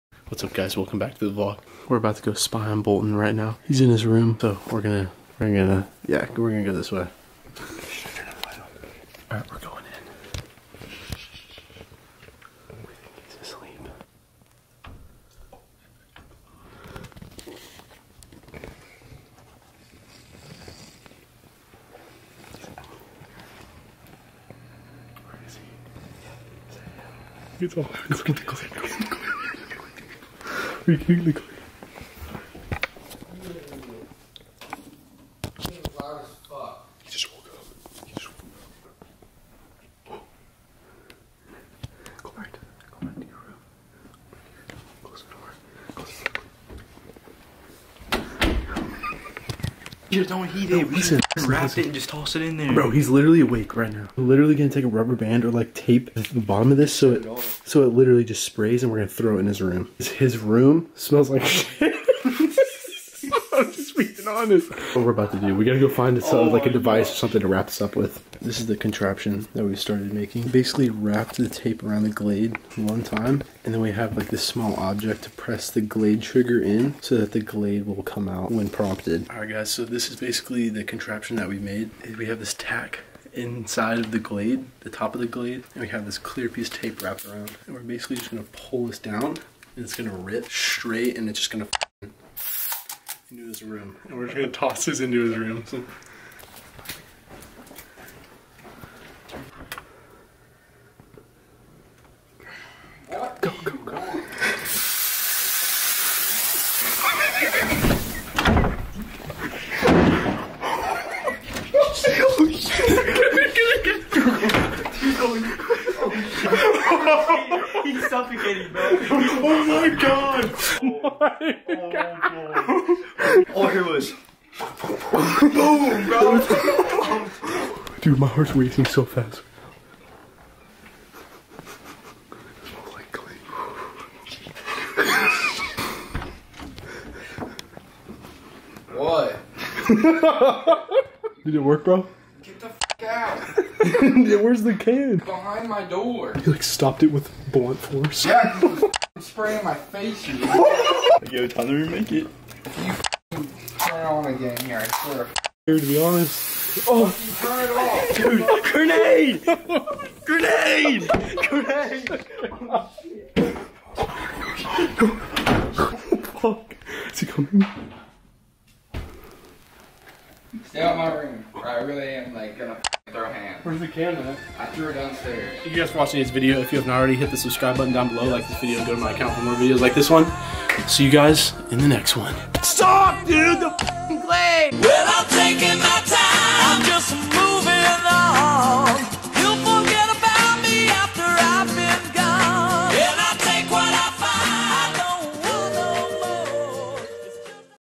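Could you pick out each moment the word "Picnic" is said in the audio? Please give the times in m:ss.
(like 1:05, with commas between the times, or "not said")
0:31.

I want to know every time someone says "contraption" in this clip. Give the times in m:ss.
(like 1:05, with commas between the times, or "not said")
1:08, 1:20.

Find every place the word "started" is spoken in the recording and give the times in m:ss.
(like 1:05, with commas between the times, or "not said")
1:09.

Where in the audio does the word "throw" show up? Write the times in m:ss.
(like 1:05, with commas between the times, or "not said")
0:59, 2:53.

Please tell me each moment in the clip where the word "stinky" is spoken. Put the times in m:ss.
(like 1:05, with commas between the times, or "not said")
not said.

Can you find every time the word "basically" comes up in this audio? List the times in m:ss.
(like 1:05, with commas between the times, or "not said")
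1:10, 1:20, 1:27.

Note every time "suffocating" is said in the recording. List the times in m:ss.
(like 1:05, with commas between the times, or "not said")
1:58.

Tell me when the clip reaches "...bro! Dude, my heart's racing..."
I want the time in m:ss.
2:07.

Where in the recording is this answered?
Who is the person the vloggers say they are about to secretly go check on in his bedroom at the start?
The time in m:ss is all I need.
0:02.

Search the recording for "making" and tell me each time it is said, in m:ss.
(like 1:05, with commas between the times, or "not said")
1:10.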